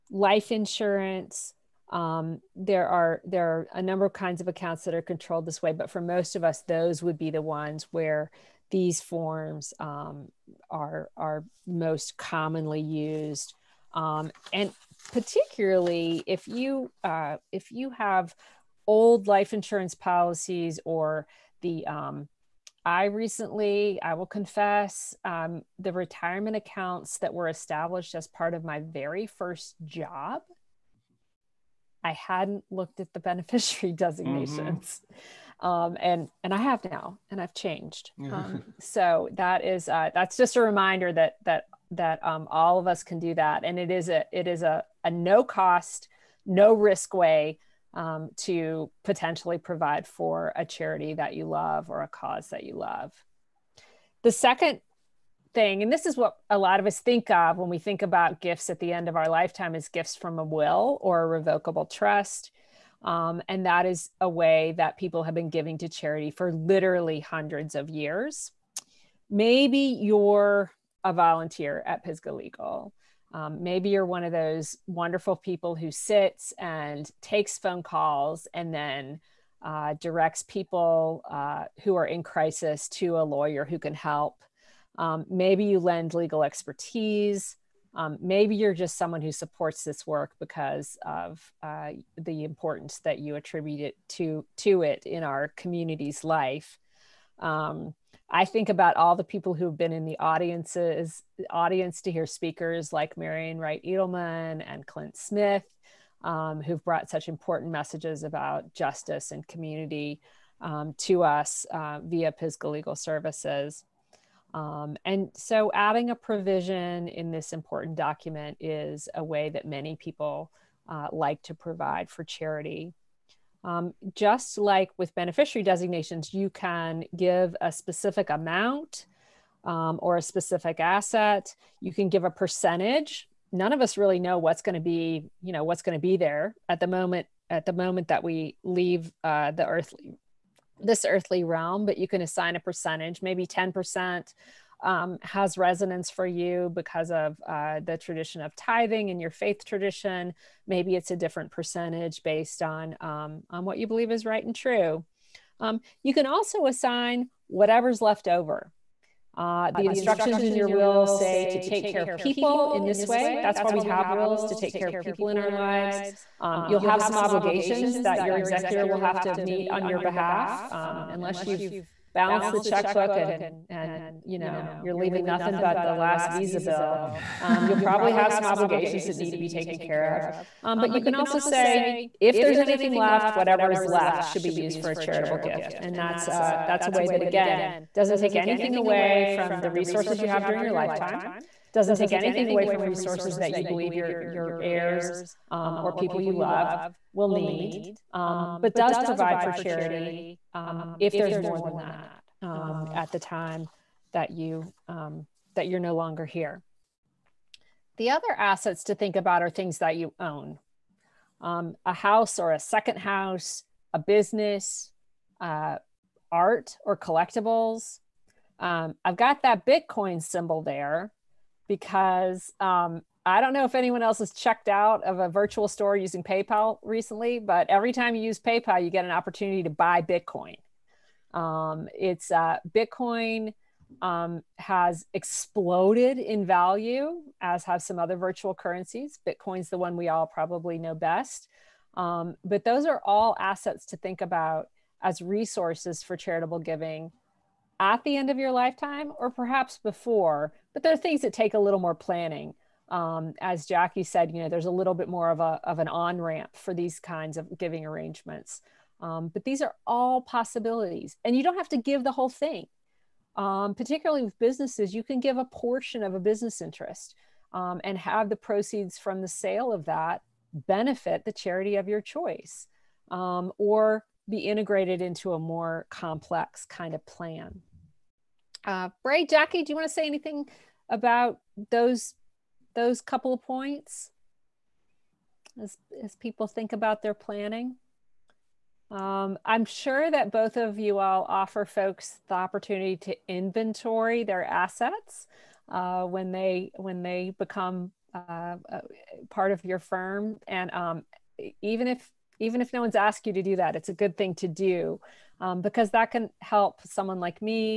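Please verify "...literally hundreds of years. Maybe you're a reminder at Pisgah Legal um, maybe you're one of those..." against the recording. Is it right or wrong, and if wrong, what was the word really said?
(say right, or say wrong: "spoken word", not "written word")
wrong: "volunteer", not "reminder".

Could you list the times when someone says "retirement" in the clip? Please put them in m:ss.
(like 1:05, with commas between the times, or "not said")
0:25.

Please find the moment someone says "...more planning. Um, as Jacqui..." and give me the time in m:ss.
4:11.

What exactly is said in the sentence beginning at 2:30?
Maybe it's a different percentage based on um, on what you believe is right and true.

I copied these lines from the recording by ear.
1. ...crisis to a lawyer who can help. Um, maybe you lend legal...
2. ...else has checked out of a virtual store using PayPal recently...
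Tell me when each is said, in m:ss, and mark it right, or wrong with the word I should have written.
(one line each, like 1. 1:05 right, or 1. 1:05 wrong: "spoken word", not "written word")
1. 1:22 right
2. 3:44 right.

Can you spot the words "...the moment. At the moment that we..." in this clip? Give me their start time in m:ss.
2:16.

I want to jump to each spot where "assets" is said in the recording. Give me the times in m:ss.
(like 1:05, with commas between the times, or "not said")
2:10, 3:28, 4:03, 4:54.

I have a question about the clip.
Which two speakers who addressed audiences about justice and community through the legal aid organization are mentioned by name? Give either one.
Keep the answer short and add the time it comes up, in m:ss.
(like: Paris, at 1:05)
Marian Wright Edelman, at 1:43.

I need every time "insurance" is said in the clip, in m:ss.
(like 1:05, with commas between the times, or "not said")
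0:00, 0:19.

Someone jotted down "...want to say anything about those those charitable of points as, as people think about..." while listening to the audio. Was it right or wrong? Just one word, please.
wrong.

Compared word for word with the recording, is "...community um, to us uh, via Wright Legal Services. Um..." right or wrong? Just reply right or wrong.
wrong.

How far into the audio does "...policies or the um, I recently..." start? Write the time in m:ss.
0:19.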